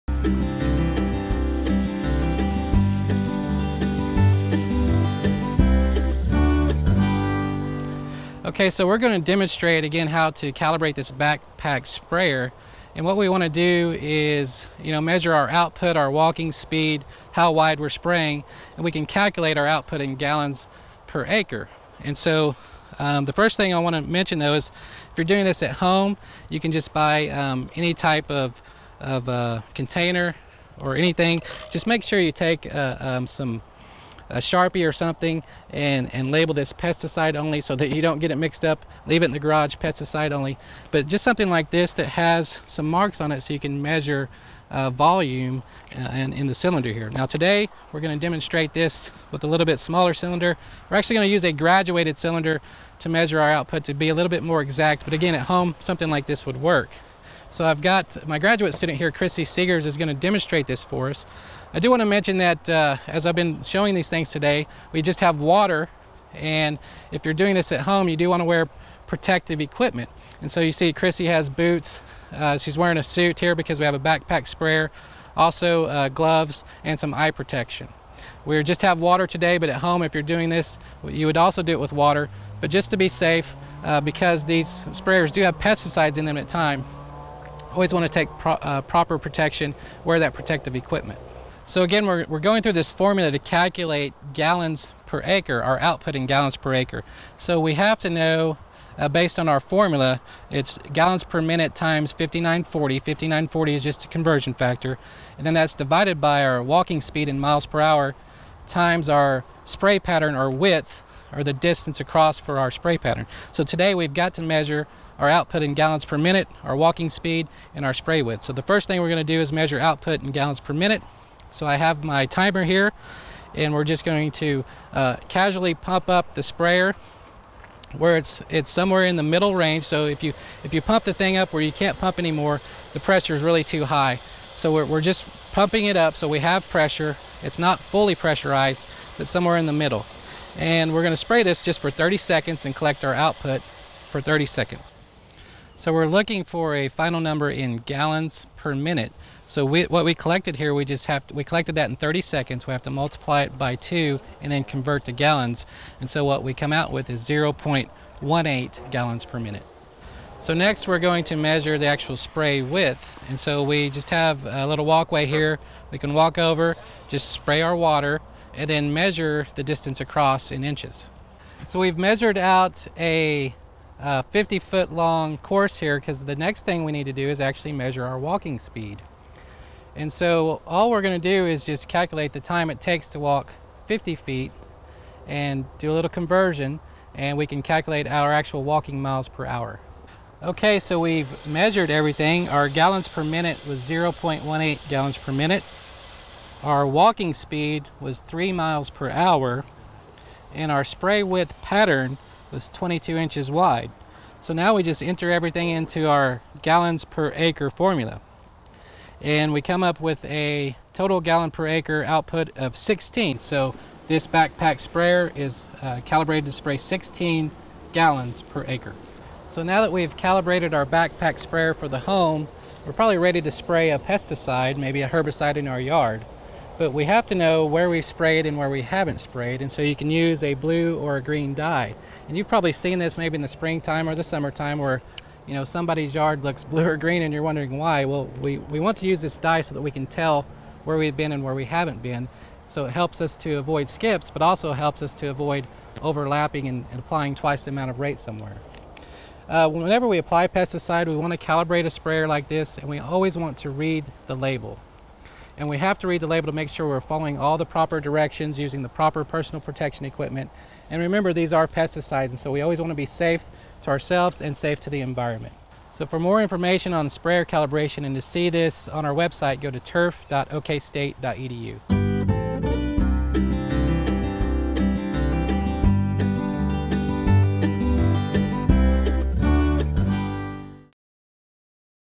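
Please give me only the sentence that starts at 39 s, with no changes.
Leave it in the garage, pesticide only.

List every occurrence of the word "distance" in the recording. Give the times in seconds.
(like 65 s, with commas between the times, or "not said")
111 s, 169 s.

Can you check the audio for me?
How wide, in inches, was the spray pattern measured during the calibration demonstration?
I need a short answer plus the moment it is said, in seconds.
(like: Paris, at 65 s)
22 inches, at 202 s.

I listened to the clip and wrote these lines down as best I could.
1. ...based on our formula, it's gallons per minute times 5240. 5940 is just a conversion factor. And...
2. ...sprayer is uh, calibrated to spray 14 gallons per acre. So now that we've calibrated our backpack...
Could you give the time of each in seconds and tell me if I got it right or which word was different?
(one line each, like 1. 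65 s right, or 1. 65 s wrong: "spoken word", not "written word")
1. 99 s wrong: "5940", not "5240"
2. 214 s wrong: "16", not "14".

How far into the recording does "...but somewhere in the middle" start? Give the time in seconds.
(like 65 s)
139 s.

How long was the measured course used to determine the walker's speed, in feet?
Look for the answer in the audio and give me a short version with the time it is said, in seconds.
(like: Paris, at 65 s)
50 feet, at 174 s.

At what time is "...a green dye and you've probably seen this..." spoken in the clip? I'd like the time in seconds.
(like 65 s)
231 s.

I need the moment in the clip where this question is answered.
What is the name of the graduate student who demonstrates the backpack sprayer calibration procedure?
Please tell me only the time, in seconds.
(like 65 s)
59 s.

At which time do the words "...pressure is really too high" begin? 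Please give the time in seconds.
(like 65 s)
132 s.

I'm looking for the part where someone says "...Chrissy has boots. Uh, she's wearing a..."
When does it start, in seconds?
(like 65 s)
70 s.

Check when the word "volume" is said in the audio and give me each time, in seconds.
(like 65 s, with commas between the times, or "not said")
44 s.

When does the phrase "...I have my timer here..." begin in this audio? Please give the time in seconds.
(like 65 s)
121 s.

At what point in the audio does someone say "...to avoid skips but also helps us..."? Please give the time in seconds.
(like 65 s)
243 s.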